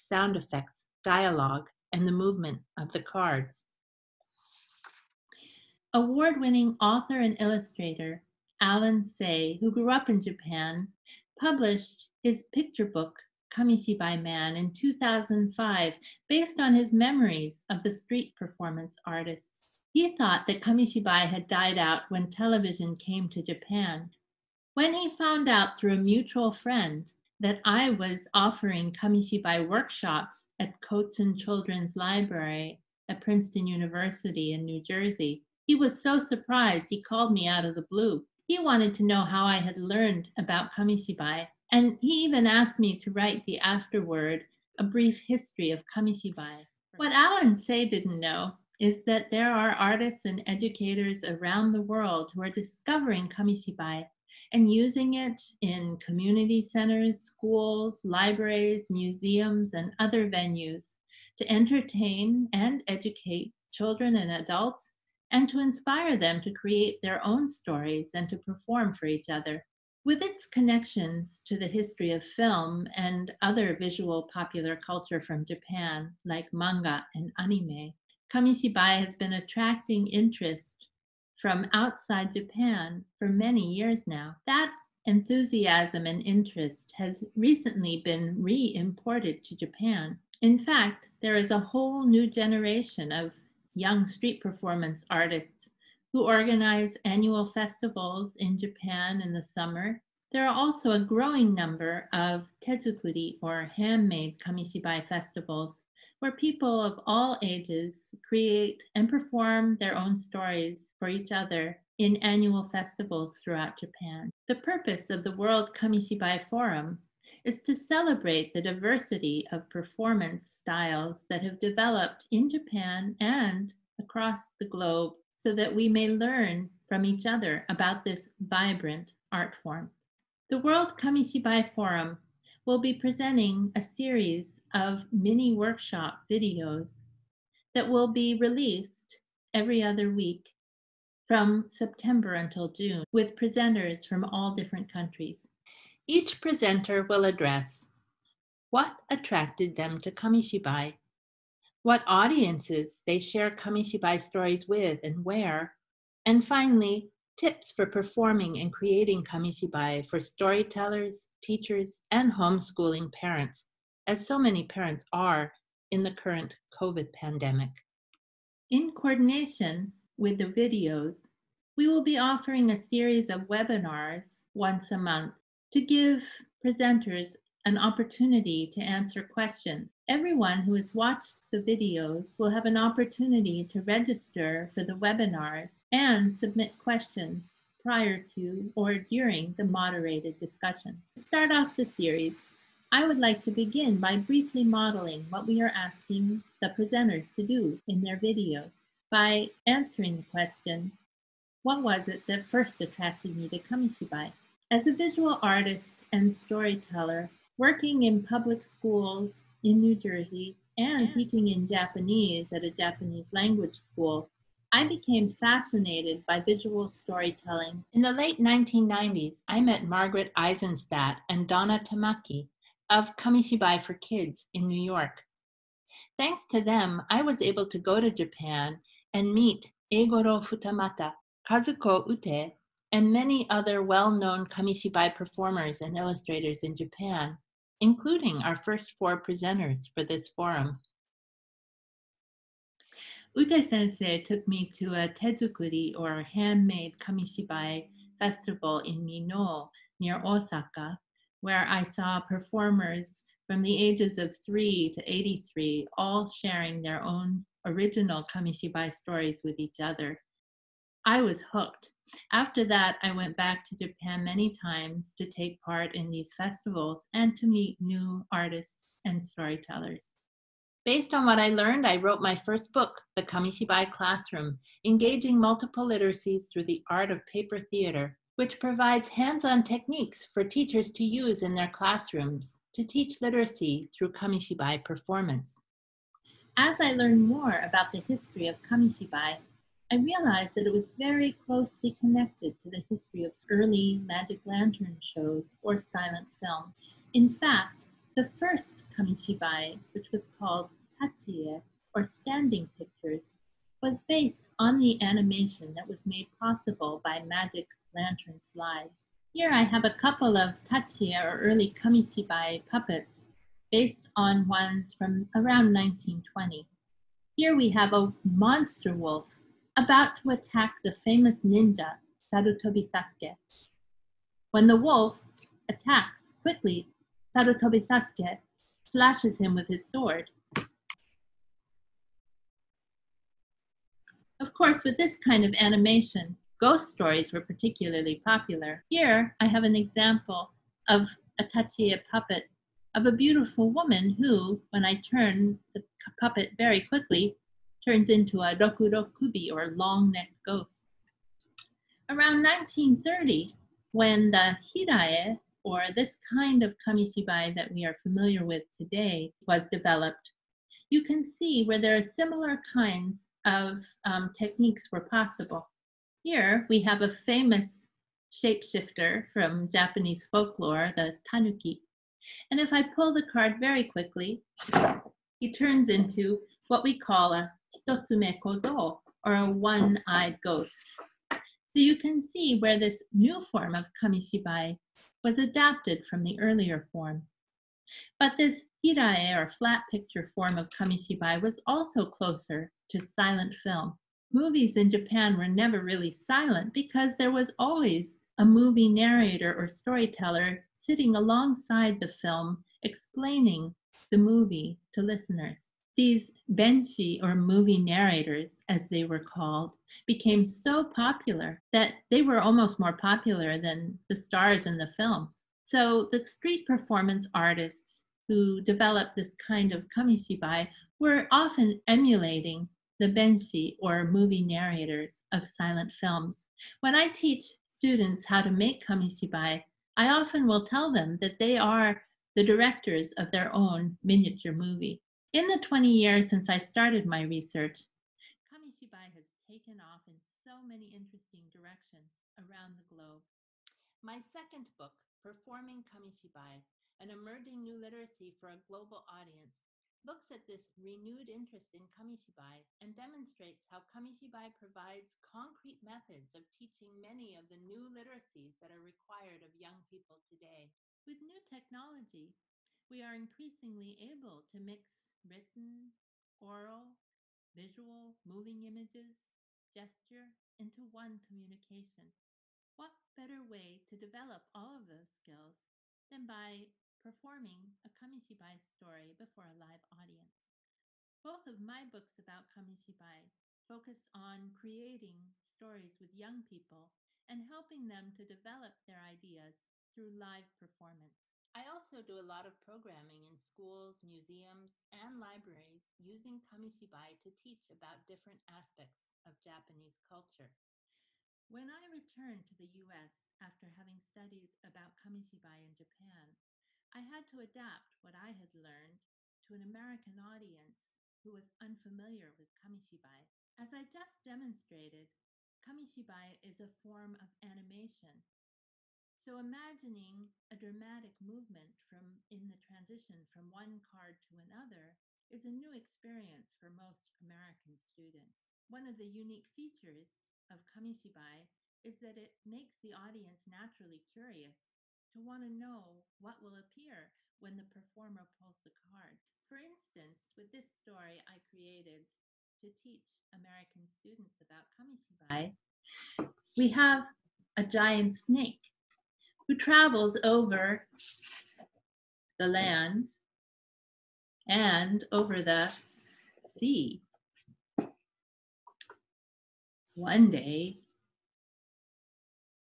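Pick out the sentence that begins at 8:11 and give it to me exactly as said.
I also do a lot of programming in schools, museums, and libraries using kamishibai to teach about different aspects of Japanese culture.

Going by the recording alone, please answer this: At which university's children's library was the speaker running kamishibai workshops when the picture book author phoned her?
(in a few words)
Princeton University.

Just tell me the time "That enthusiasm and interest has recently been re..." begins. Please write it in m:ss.
1:24.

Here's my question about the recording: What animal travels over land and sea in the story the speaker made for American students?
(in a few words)
Giant snake.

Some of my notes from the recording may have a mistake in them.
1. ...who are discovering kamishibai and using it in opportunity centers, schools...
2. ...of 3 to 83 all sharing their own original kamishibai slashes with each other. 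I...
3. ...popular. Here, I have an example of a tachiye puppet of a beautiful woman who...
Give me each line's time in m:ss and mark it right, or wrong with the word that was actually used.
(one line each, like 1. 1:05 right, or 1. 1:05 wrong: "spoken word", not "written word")
1. 0:52 wrong: "community", not "opportunity"
2. 4:14 wrong: "stories", not "slashes"
3. 5:38 right.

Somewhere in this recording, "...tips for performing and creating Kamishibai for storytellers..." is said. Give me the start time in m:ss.
2:37.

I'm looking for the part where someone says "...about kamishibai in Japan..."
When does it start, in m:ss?
8:24.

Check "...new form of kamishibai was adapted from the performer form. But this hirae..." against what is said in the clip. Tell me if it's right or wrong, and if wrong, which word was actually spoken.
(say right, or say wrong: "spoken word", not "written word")
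wrong: "earlier", not "performer".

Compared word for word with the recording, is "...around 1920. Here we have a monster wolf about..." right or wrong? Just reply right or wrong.
right.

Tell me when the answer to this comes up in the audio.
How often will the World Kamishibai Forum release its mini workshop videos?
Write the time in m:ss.
2:19.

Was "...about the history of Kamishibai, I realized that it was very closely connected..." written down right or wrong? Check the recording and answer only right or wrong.
right.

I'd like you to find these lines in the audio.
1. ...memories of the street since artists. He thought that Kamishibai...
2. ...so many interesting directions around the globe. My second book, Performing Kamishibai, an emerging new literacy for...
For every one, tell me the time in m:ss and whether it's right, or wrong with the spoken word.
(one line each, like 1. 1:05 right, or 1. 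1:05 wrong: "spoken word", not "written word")
1. 0:16 wrong: "performance", not "since"
2. 7:20 right.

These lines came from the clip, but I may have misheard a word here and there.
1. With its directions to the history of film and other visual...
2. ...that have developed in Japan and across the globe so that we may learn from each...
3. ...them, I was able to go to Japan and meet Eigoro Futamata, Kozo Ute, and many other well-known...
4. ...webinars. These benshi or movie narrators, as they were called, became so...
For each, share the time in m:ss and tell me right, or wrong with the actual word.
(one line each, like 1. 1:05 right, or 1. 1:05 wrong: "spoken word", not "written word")
1. 1:10 wrong: "connections", not "directions"
2. 2:01 right
3. 3:46 wrong: "Kazuko", not "Kozo"
4. 6:45 wrong: "listeners", not "webinars".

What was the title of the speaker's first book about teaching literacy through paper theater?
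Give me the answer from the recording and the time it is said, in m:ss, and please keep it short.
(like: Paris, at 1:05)
The Kamishibai Classroom, at 4:33.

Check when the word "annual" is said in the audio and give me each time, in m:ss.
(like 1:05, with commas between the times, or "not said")
1:37, 1:52.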